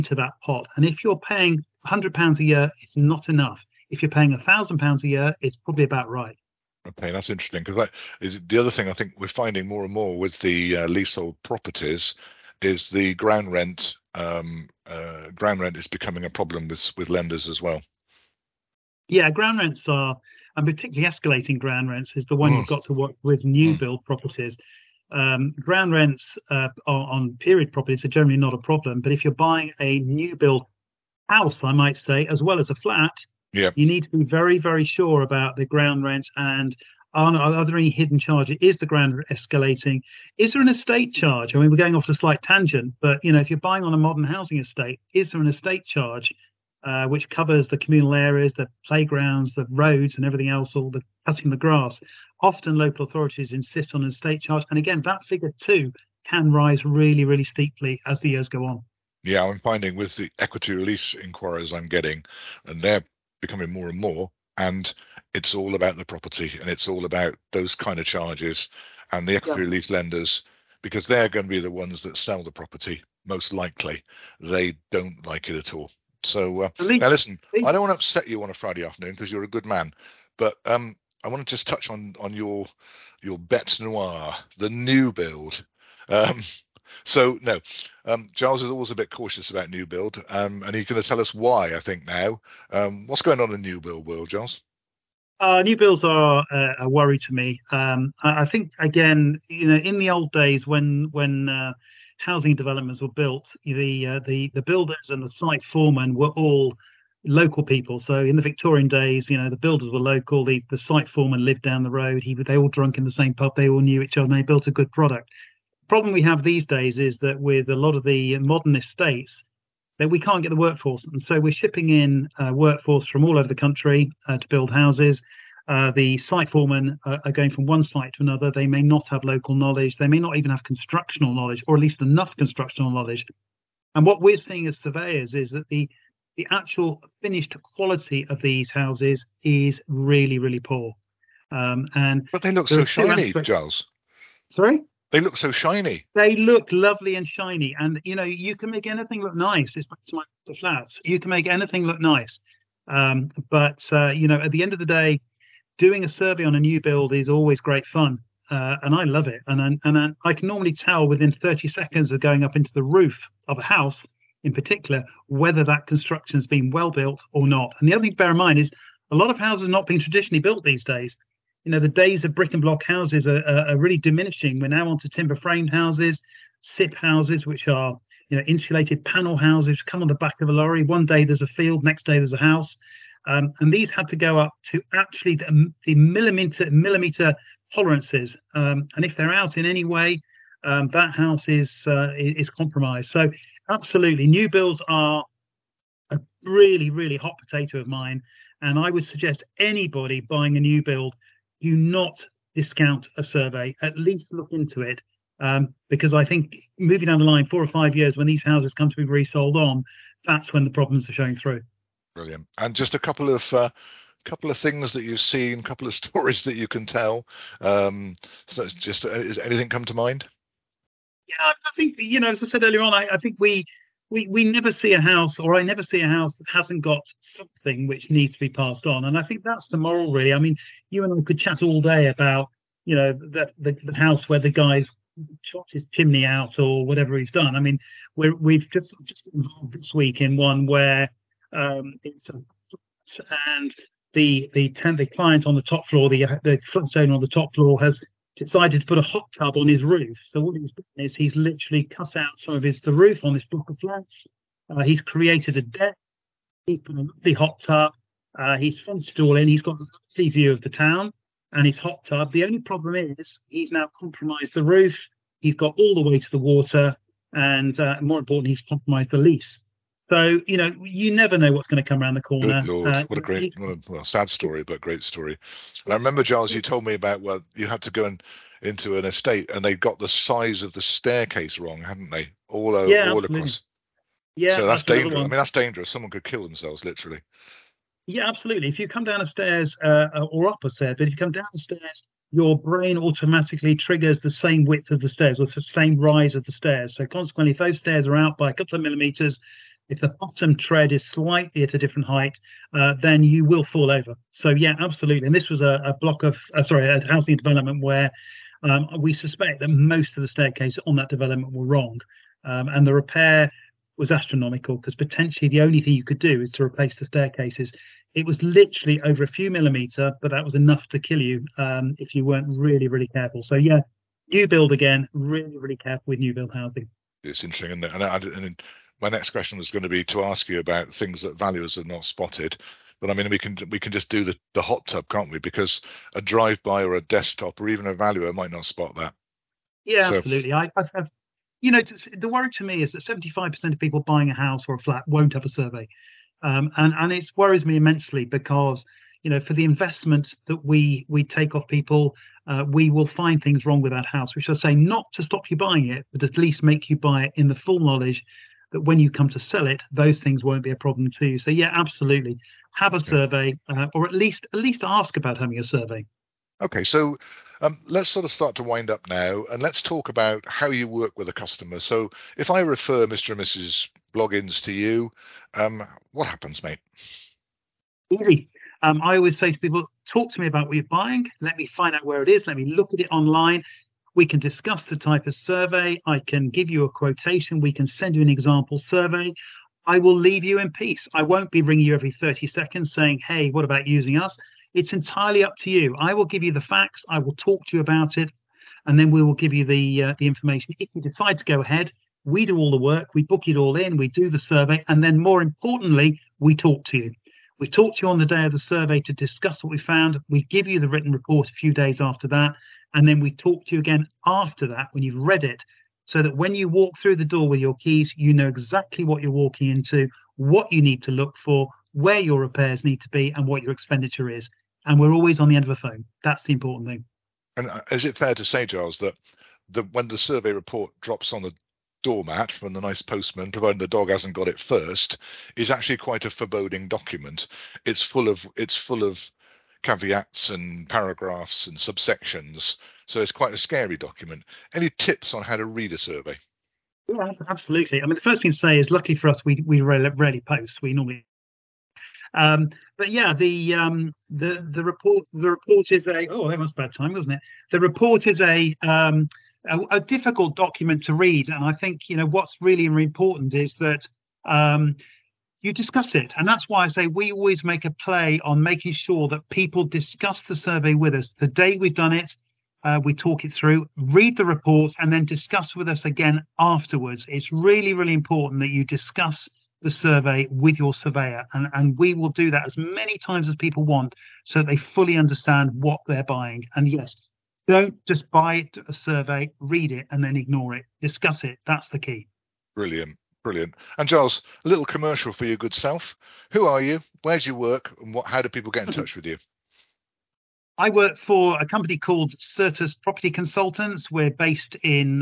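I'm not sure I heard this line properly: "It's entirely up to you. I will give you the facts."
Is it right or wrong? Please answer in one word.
right.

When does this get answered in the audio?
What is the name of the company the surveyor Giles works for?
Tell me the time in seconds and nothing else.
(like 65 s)
502 s.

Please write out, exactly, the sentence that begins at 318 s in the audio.
It was literally over a few millimeter, but that was enough to kill you um, if you weren't really, really careful.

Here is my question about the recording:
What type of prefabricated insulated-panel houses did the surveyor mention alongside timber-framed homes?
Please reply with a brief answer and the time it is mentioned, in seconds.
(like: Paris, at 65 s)
SIP houses, at 176 s.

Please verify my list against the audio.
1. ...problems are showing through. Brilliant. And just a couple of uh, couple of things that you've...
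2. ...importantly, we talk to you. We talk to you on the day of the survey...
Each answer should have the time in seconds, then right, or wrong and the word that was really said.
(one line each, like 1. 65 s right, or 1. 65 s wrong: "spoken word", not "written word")
1. 210 s right
2. 405 s right.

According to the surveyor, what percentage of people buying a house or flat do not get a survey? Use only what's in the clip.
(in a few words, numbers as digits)
75%.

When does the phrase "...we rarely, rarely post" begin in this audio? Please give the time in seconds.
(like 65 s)
449 s.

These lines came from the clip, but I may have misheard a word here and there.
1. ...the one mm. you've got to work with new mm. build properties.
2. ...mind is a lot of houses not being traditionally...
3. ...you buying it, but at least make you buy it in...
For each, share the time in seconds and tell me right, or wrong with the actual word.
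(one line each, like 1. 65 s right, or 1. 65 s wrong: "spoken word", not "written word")
1. 22 s right
2. 168 s right
3. 355 s right.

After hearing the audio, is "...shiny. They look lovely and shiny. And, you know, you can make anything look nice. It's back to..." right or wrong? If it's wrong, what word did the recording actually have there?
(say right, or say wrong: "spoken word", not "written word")
right.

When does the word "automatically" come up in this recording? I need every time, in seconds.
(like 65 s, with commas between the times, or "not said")
292 s.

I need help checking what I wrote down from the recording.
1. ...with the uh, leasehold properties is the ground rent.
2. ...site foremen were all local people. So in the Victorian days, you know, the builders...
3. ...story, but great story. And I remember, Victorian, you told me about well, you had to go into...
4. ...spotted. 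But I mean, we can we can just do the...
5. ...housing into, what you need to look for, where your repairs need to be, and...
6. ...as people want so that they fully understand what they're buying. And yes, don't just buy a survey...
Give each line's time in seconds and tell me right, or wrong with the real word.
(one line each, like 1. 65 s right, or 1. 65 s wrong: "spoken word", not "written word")
1. 10 s right
2. 105 s right
3. 274 s wrong: "Giles", not "Victorian"
4. 332 s right
5. 419 s wrong: "walking", not "housing"
6. 483 s right.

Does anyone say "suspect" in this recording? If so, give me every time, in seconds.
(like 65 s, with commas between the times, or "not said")
309 s.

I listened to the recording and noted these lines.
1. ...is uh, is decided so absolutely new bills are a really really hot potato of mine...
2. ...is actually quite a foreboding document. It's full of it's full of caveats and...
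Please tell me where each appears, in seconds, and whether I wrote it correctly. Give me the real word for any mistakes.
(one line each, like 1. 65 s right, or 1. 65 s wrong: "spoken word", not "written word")
1. 191 s wrong: "compromised", not "decided"
2. 435 s right.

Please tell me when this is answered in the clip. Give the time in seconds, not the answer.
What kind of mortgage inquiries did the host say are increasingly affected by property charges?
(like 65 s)
60 s.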